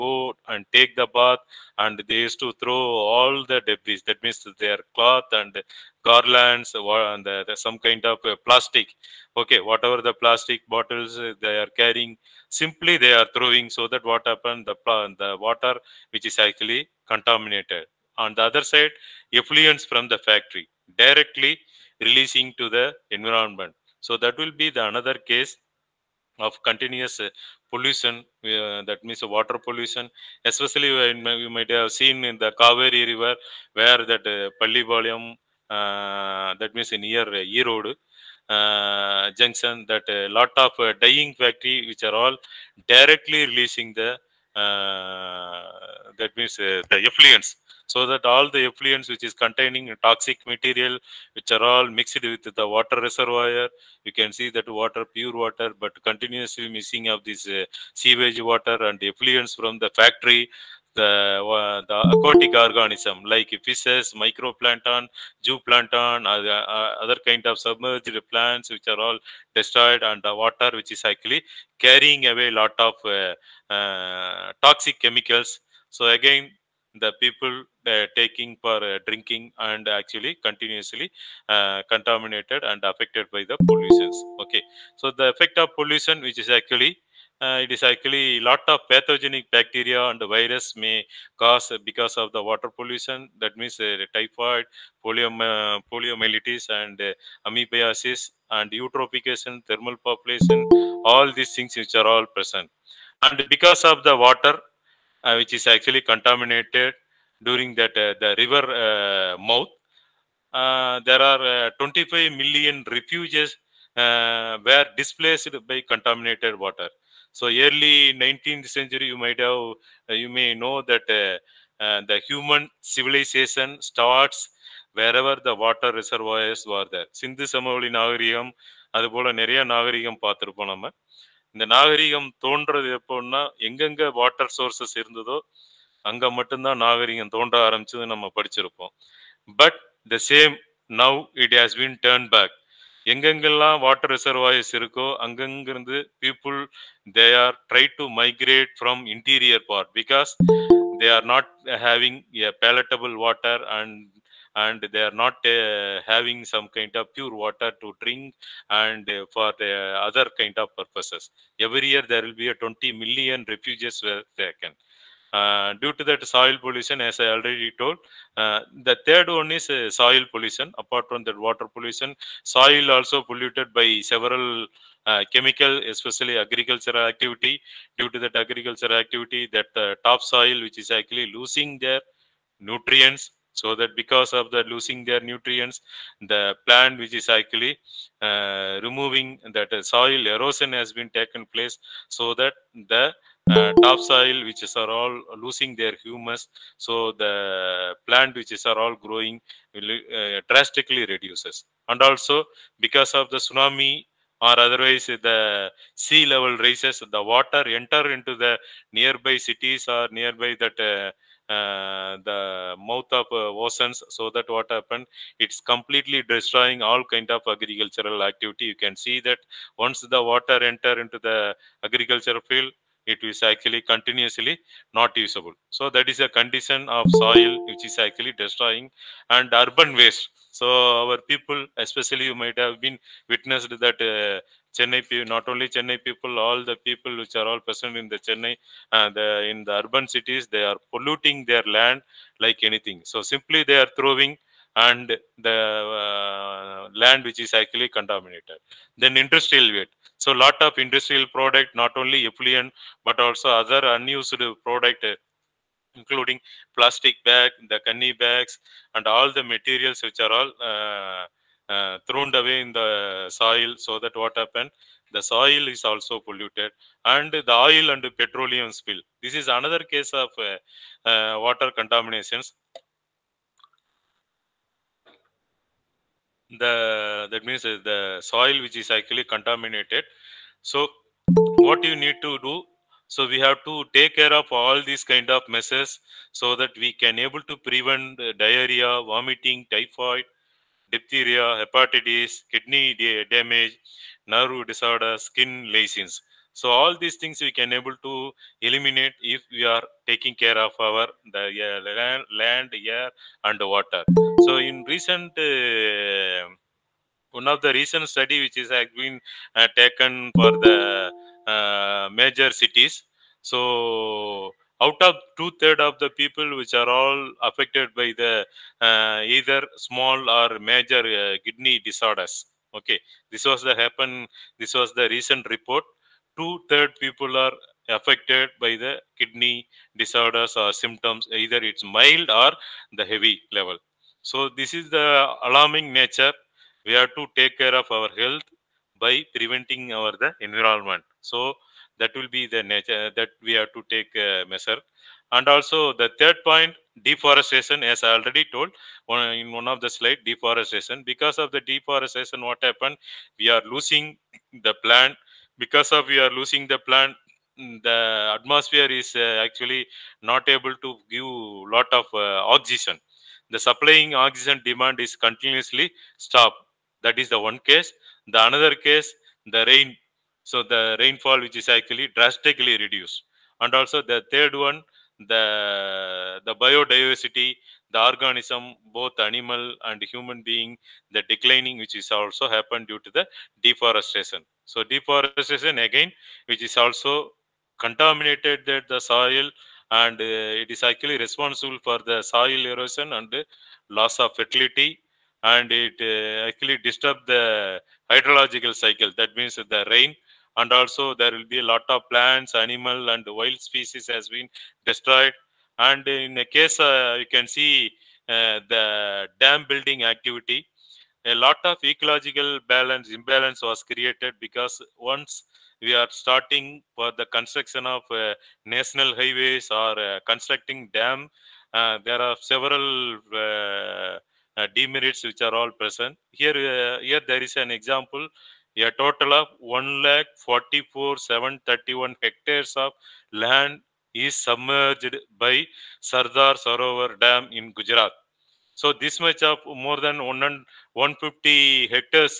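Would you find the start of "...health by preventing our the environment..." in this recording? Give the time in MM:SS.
05:38.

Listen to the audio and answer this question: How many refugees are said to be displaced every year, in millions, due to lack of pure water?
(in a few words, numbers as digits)
20 million.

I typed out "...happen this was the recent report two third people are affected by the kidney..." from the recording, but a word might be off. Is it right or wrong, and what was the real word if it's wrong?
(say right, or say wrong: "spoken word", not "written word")
right.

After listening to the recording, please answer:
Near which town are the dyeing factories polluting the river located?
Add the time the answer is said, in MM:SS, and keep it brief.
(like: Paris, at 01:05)
Erode, at 00:37.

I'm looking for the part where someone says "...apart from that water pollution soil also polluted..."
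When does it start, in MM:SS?
02:50.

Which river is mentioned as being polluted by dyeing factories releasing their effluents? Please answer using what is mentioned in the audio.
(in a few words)
Kaveri.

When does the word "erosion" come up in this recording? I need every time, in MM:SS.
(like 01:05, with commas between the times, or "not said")
03:10, 06:32.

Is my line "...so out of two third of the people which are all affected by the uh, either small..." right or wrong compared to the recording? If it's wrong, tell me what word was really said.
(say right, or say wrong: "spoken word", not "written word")
right.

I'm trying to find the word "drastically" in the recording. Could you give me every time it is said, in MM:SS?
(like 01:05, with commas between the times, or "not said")
03:20, 06:12.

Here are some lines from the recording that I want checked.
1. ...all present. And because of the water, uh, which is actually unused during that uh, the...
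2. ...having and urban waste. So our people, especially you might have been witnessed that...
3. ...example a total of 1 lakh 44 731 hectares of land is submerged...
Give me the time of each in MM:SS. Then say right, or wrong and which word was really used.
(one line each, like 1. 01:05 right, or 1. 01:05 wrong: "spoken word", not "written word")
1. 01:42 wrong: "contaminated", not "unused"
2. 03:48 wrong: "destroying", not "having"
3. 07:07 right.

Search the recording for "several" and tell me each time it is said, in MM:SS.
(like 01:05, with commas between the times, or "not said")
02:54, 07:02.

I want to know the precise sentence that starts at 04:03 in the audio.
So simply they are throwing and the uh, land which is actually contaminated.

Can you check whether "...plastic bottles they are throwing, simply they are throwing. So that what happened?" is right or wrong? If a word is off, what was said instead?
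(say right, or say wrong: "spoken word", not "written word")
wrong: "carrying", not "throwing".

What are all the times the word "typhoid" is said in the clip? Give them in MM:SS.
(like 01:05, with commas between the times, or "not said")
01:34, 04:49.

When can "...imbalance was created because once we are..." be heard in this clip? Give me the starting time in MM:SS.
06:53.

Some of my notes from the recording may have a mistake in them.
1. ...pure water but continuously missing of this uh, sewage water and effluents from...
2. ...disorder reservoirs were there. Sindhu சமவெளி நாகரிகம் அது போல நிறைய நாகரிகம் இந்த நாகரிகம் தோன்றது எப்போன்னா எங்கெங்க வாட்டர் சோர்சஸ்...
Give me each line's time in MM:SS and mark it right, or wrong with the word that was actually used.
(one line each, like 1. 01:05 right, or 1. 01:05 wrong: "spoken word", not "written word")
1. 00:55 right
2. 02:05 wrong: "water", not "disorder".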